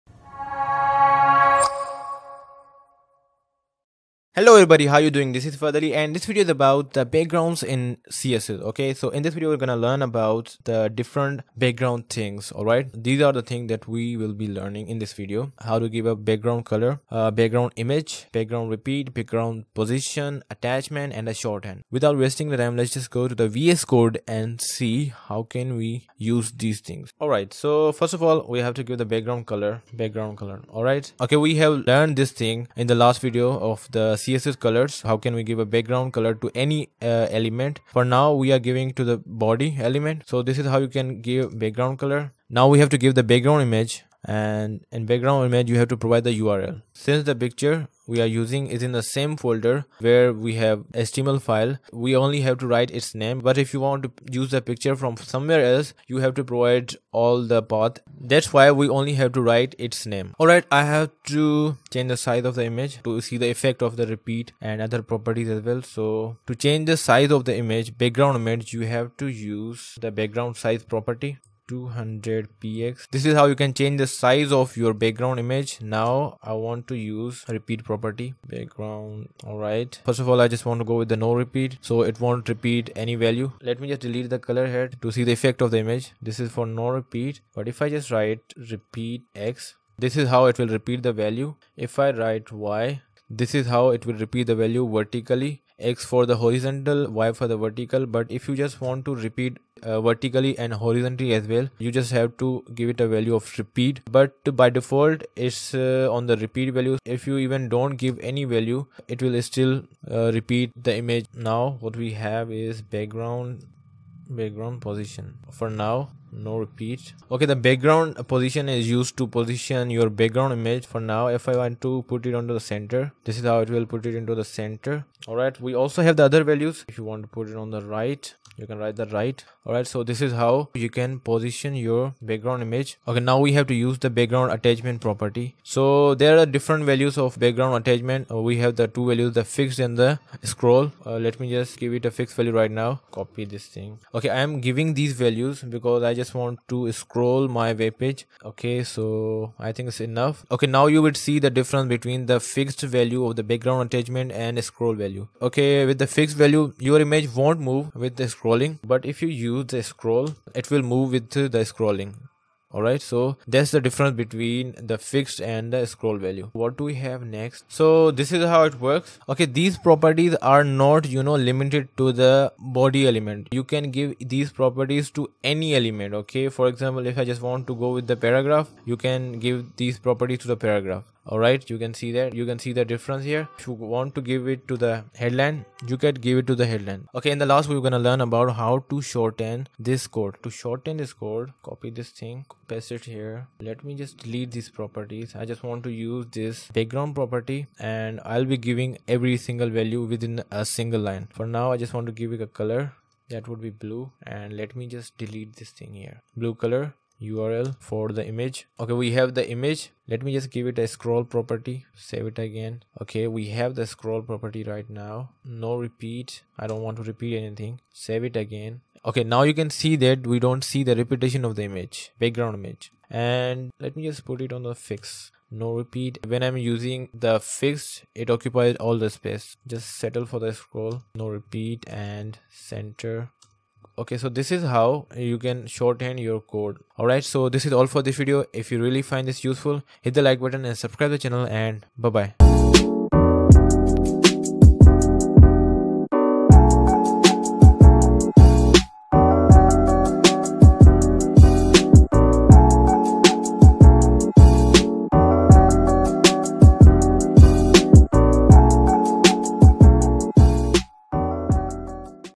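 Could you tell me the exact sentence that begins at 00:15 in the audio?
How to give a background color, uh, background image, background repeat, background position, attachment, and a shorthand.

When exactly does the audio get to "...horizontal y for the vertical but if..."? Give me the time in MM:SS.
01:36.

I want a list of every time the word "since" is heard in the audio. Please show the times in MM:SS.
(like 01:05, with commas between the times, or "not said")
00:46.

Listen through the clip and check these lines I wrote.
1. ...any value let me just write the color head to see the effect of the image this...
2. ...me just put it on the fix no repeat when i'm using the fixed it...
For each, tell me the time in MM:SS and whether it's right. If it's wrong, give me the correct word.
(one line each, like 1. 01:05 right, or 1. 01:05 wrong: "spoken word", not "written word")
1. 01:22 wrong: "delete", not "write"
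2. 03:43 right.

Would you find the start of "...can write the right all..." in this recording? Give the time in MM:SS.
02:08.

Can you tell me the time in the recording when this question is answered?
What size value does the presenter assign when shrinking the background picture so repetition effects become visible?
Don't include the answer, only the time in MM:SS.
01:11.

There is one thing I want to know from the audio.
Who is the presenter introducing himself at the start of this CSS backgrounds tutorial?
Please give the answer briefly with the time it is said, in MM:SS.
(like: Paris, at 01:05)
Fahad Ali, at 00:05.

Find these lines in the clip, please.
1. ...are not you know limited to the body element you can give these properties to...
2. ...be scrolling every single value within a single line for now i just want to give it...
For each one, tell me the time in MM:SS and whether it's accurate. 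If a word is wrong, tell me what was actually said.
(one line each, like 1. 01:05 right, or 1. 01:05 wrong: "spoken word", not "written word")
1. 02:50 right
2. 03:18 wrong: "giving", not "scrolling".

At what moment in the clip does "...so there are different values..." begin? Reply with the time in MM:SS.
02:15.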